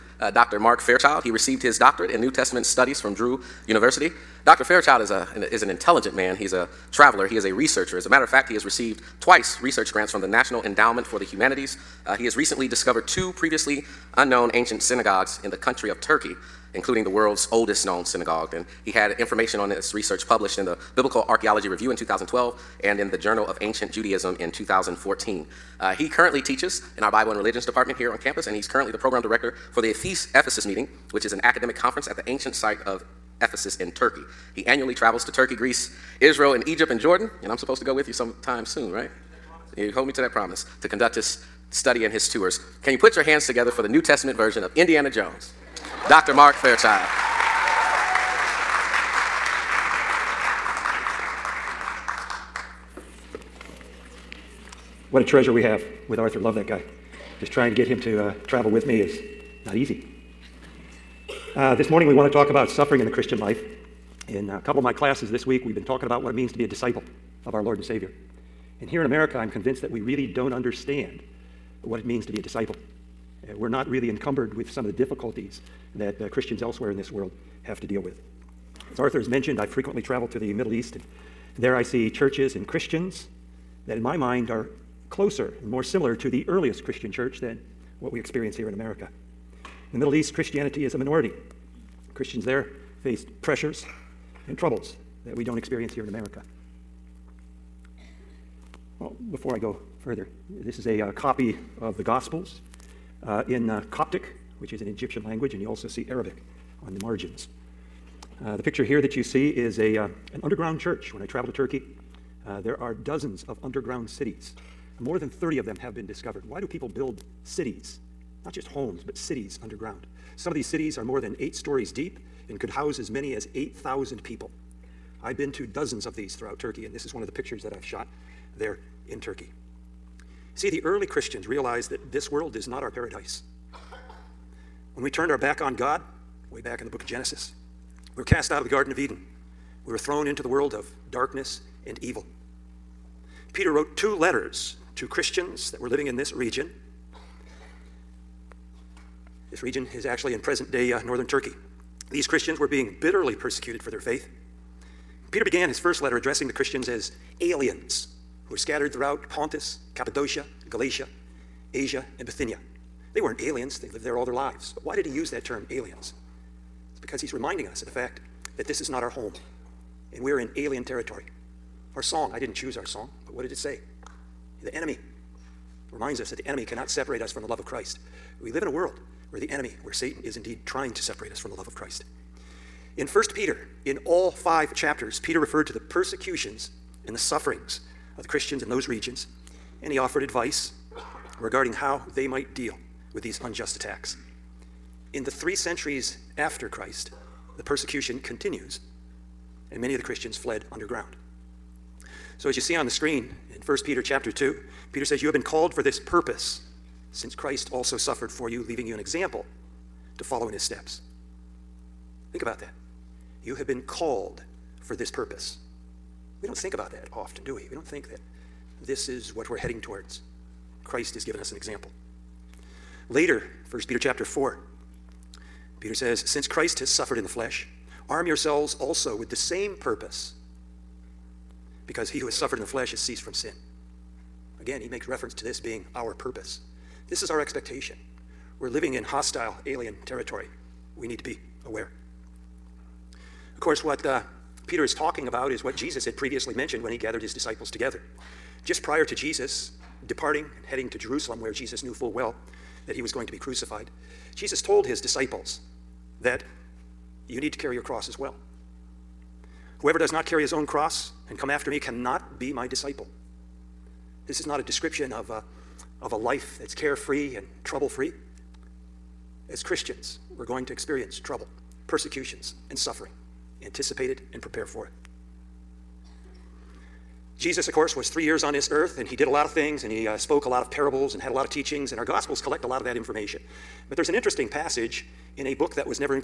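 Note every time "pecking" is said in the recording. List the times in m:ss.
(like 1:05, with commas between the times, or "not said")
not said.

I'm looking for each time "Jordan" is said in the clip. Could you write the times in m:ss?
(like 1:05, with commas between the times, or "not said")
0:36.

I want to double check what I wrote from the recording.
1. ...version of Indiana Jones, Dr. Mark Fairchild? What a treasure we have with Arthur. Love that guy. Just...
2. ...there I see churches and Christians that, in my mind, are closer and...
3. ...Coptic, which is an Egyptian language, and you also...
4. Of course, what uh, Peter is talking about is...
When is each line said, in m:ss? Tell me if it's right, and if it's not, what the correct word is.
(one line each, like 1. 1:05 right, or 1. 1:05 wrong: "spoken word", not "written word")
1. 0:44 right
2. 1:21 right
3. 1:43 right
4. 4:03 right.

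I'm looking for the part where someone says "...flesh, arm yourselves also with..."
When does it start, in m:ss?
3:47.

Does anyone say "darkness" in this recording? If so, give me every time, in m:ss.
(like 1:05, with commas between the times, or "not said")
2:21.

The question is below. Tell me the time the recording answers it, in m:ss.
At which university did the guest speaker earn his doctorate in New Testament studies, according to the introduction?
0:03.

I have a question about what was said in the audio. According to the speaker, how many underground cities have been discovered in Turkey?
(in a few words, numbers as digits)
more than 30.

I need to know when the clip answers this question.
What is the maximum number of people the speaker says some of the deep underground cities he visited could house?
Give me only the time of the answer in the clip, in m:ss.
2:03.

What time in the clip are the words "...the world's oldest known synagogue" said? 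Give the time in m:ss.
0:17.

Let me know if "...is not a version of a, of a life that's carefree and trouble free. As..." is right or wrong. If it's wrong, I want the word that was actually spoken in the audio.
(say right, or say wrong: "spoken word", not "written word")
wrong: "description", not "version".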